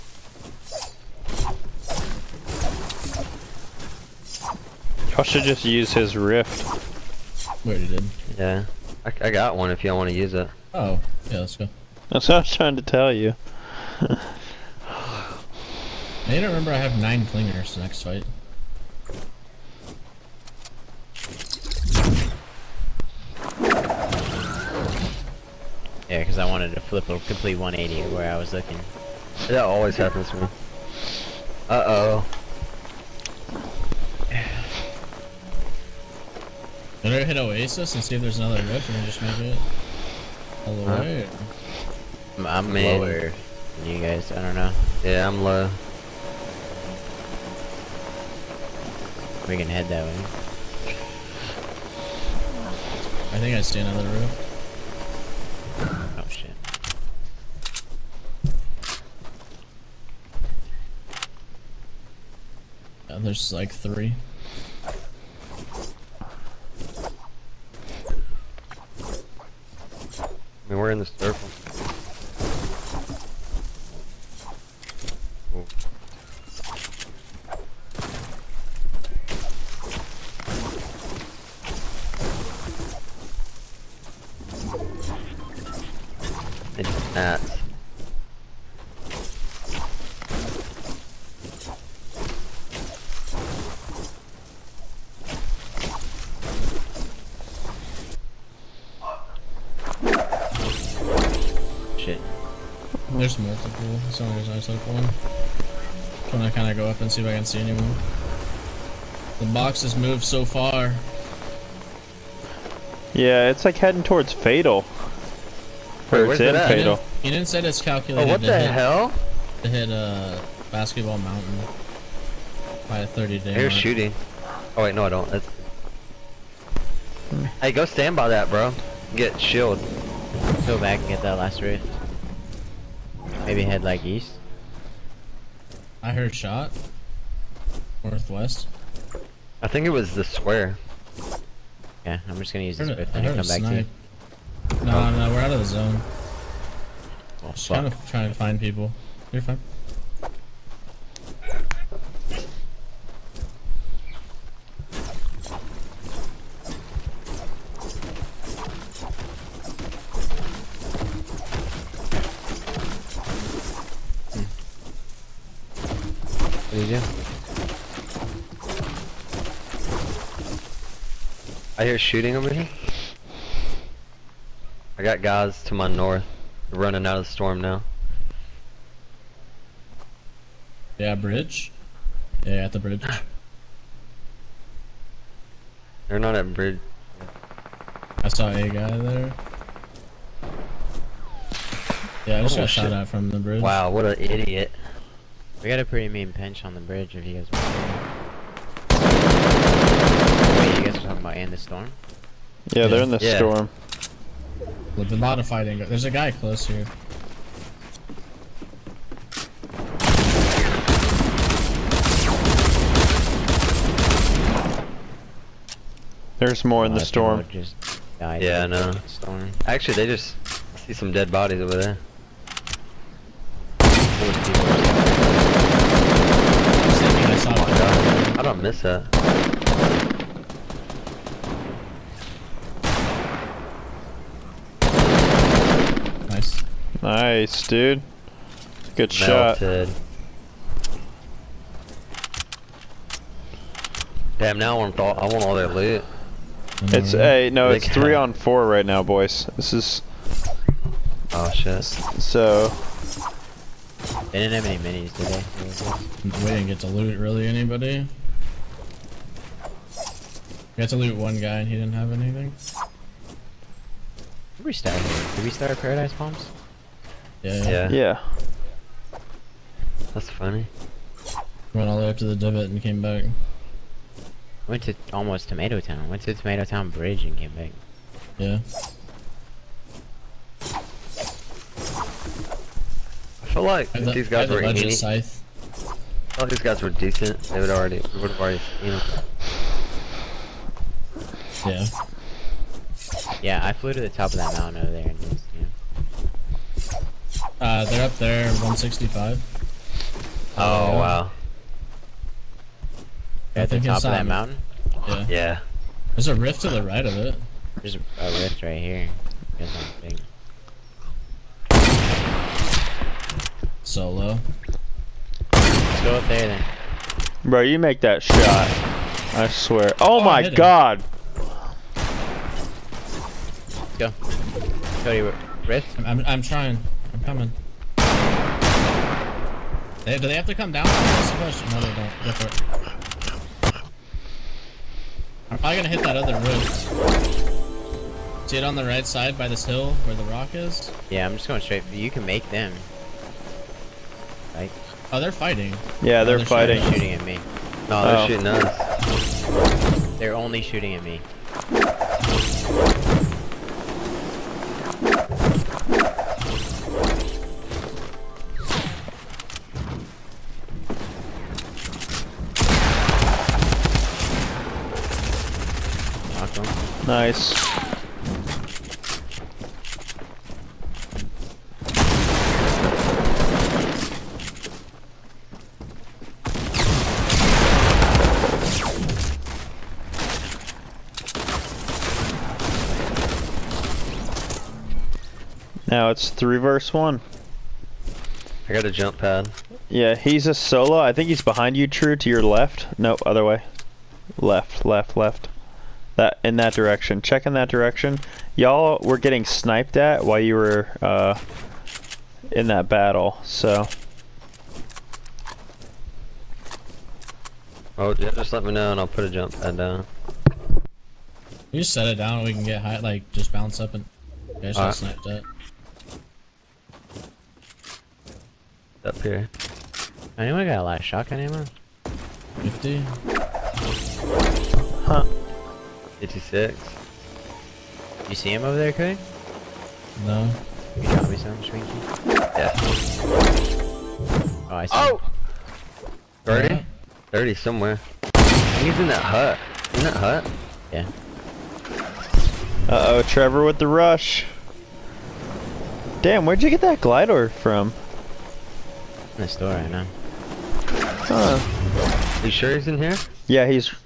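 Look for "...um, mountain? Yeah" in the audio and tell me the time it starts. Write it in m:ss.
5:04.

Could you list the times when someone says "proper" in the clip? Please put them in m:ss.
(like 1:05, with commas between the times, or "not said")
not said.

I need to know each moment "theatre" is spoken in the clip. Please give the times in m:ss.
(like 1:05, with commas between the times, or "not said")
not said.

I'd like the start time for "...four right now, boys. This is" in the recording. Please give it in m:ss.
4:08.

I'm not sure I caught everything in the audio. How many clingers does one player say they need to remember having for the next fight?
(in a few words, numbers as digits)
9.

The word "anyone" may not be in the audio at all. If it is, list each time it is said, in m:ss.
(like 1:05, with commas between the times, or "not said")
1:47, 7:00.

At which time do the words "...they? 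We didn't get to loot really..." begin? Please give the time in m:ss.
4:16.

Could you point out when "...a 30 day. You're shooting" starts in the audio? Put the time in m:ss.
2:02.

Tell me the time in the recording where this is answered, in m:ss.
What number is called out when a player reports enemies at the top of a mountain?
4:58.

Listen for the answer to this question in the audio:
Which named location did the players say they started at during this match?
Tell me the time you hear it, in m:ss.
4:25.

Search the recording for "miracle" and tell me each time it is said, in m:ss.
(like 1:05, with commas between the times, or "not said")
not said.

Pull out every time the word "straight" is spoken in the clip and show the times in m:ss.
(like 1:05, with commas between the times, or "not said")
5:41.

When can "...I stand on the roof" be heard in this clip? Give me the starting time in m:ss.
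0:53.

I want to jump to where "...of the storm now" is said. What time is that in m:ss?
2:57.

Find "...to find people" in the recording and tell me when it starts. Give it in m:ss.
2:28.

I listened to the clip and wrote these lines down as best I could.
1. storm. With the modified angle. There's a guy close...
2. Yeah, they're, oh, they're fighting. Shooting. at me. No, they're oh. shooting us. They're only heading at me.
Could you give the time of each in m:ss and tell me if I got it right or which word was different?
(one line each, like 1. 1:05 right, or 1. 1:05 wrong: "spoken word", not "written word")
1. 3:23 right
2. 5:46 wrong: "shooting", not "heading".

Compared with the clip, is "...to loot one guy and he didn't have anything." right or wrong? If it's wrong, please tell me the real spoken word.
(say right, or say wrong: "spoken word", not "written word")
right.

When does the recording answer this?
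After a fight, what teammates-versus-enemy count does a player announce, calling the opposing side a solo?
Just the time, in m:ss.
6:26.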